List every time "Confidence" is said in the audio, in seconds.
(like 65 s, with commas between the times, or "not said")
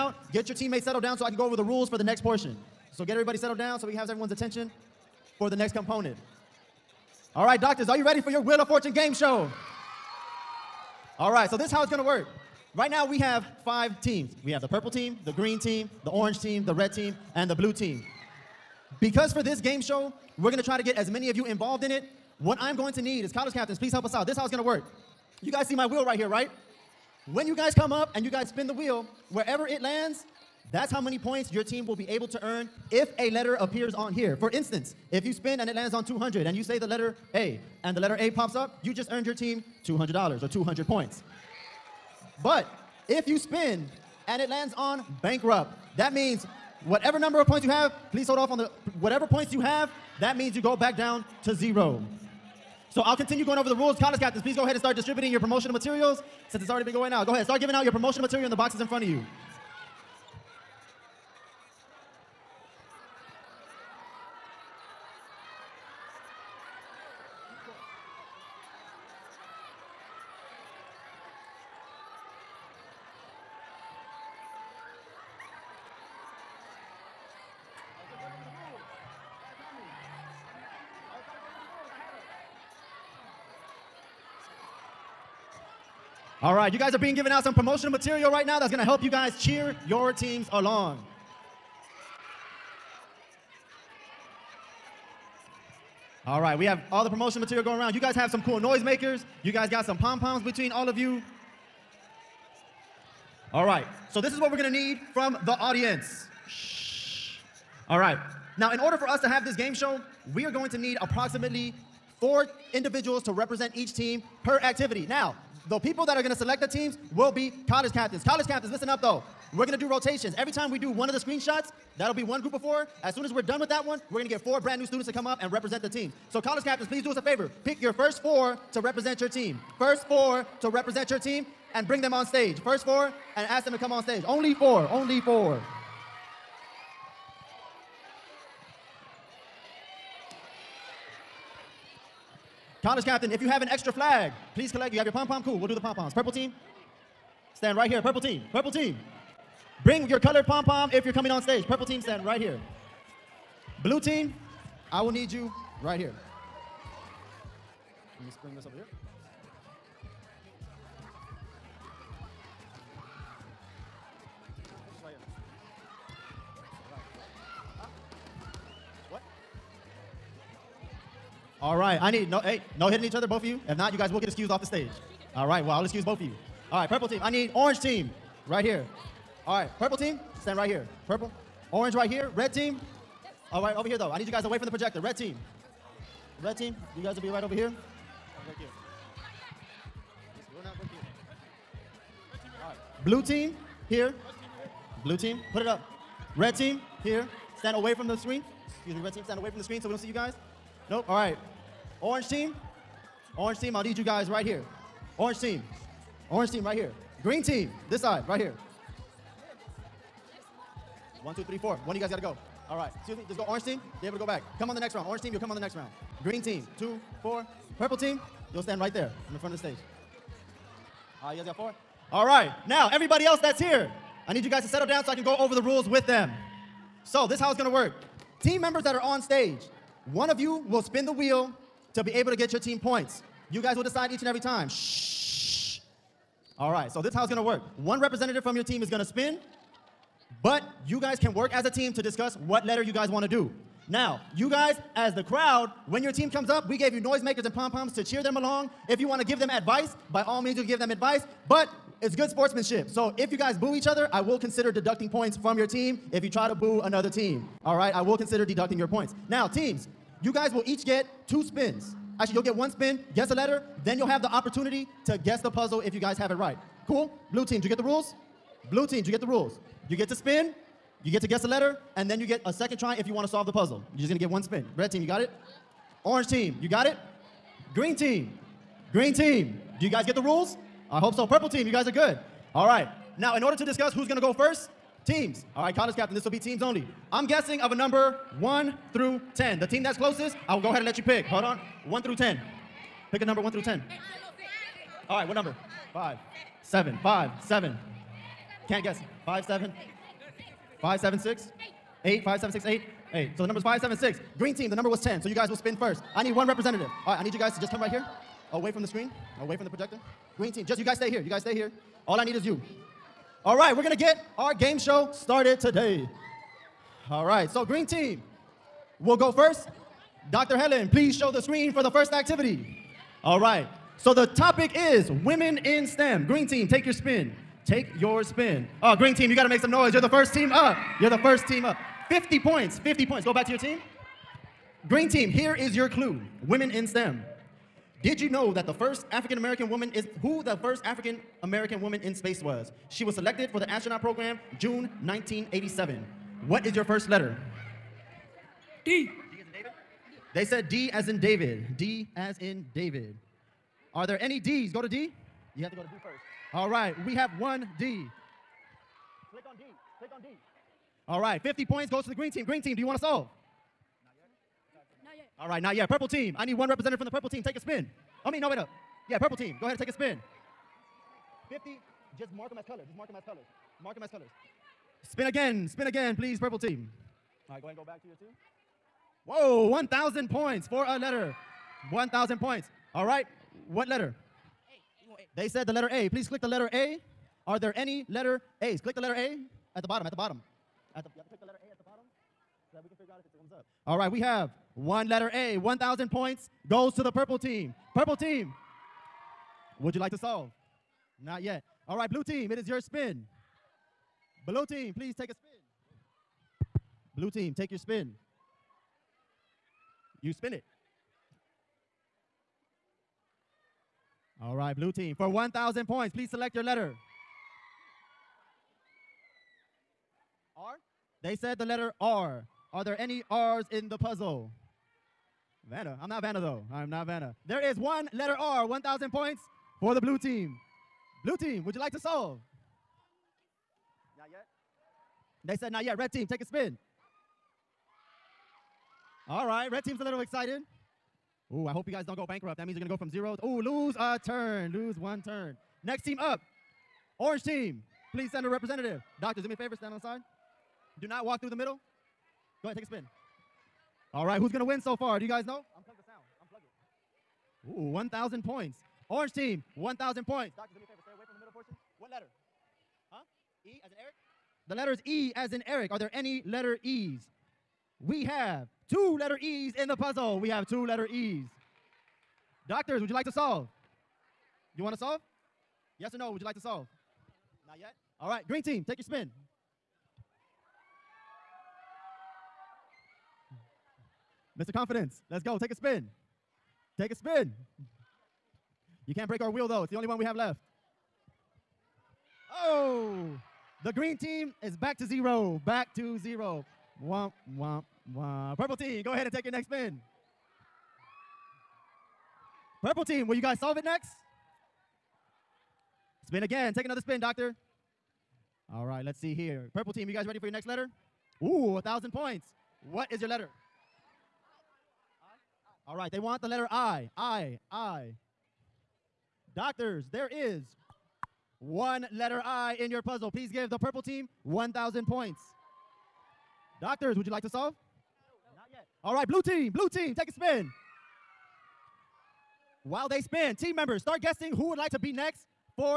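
484 s.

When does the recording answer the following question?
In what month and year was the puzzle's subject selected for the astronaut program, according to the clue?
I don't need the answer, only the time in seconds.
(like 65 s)
344 s.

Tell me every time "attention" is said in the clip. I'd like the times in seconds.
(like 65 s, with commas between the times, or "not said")
4 s.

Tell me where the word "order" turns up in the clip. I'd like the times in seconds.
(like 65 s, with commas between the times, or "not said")
108 s, 283 s.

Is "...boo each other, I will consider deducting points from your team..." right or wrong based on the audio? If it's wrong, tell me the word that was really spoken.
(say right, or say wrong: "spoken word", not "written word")
right.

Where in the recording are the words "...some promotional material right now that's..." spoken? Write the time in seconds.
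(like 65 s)
87 s.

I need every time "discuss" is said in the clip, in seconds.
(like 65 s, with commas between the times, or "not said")
242 s, 283 s.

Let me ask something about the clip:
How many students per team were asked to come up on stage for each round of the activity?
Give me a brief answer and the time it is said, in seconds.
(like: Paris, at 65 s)
4, at 112 s.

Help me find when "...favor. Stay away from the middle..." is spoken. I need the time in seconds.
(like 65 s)
460 s.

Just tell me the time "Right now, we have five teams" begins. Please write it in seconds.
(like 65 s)
12 s.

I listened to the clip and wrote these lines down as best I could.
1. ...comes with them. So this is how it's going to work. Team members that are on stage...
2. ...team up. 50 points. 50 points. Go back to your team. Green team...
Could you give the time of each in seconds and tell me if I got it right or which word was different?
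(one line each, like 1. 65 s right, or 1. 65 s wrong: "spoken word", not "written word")
1. 225 s wrong: "rules", not "comes"
2. 331 s right.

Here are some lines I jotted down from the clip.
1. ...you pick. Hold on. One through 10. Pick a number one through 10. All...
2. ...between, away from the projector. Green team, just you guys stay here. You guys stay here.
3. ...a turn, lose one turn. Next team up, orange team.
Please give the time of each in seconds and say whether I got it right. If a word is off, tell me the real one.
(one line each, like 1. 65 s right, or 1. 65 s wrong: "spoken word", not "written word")
1. 290 s right
2. 308 s wrong: "screen", not "between"
3. 443 s right.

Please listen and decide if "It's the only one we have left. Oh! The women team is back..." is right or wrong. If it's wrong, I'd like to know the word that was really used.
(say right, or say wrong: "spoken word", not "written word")
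wrong: "green", not "women".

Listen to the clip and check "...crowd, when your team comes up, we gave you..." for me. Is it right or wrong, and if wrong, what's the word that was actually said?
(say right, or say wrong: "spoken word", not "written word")
right.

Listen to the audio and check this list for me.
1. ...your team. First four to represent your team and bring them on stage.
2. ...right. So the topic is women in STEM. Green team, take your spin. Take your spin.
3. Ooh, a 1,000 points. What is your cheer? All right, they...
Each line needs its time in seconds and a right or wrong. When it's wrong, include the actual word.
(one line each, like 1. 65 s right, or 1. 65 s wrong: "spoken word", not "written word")
1. 129 s right
2. 323 s right
3. 511 s wrong: "letter", not "cheer".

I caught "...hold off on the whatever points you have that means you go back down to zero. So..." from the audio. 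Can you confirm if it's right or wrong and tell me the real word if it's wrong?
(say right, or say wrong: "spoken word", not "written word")
right.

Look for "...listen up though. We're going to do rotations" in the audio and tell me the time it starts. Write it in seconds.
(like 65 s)
118 s.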